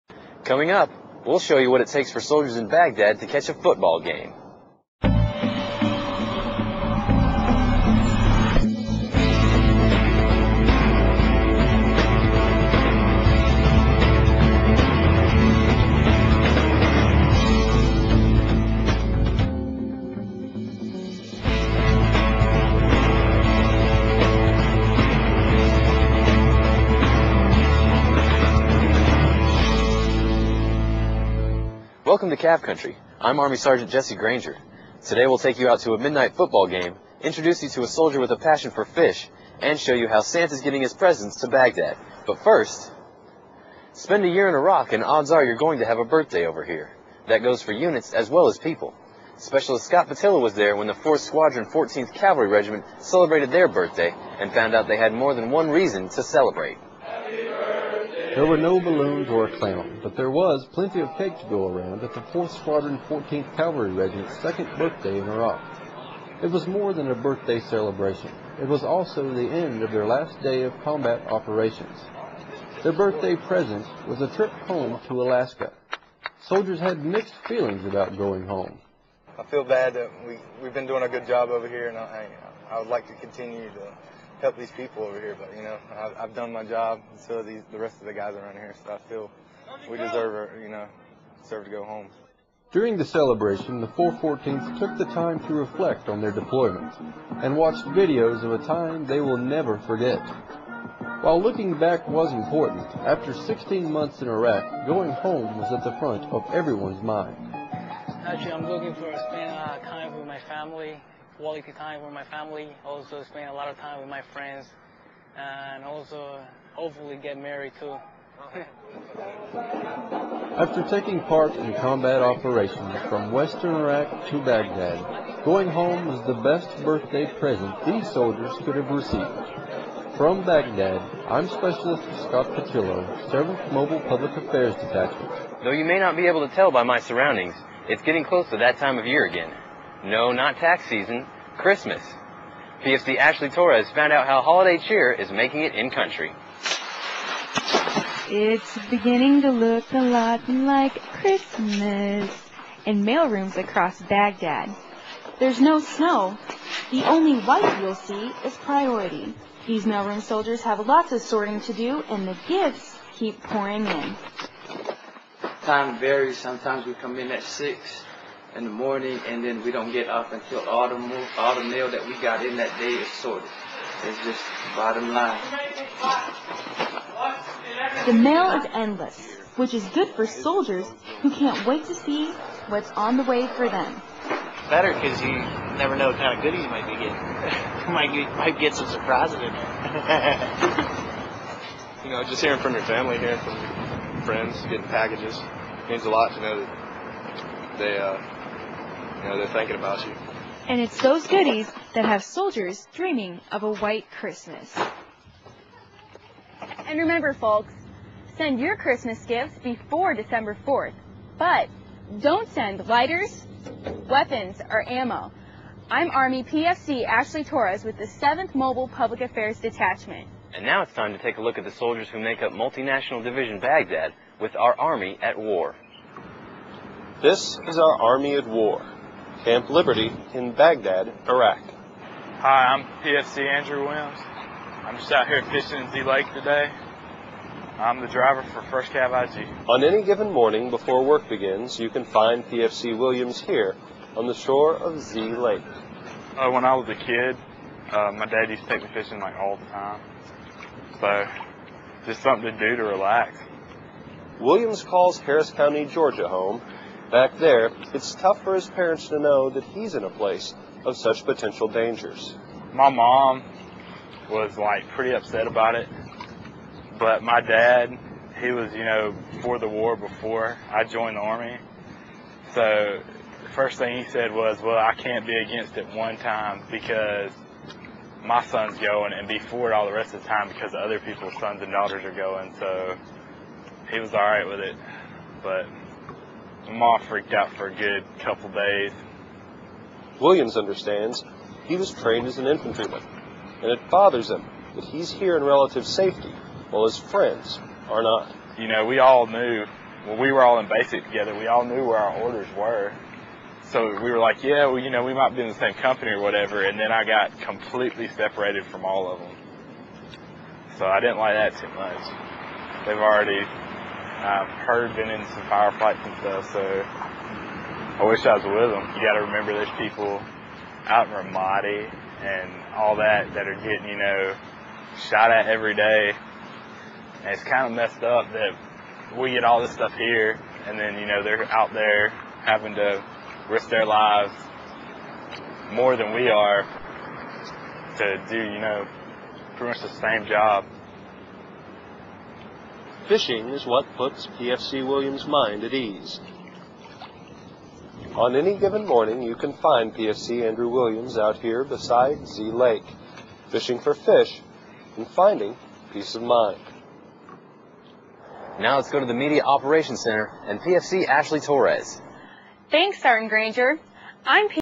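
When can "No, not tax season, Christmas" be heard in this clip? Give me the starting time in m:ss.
2:20.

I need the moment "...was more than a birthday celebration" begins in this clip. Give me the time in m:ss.
1:06.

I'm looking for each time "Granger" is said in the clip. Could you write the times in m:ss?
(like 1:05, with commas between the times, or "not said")
0:34, 6:03.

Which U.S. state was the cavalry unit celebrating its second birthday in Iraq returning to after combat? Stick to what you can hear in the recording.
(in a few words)
Alaska.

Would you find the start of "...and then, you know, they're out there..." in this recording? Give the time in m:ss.
5:30.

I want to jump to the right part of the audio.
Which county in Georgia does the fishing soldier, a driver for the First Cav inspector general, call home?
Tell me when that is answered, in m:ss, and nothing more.
4:15.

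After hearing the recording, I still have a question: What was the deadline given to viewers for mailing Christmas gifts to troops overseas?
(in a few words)
December 4th.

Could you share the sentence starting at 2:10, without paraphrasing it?
From Baghdad, I'm Specialist Scott Patillo, 7th Mobile Public Affairs Detachment.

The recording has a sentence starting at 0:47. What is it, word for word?
That goes for units as well as people.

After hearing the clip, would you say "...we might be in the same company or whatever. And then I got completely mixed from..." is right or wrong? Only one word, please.
wrong.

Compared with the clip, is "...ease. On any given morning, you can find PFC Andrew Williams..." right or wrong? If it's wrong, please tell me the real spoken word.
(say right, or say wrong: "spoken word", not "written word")
right.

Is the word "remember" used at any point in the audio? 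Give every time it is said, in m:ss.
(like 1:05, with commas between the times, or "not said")
3:26, 5:19.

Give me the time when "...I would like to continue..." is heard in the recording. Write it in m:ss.
1:22.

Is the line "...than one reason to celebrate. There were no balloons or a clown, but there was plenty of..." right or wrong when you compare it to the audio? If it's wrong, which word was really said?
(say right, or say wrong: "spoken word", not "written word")
right.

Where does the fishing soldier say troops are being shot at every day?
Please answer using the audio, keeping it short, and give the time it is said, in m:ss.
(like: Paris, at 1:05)
Ramadi, at 5:21.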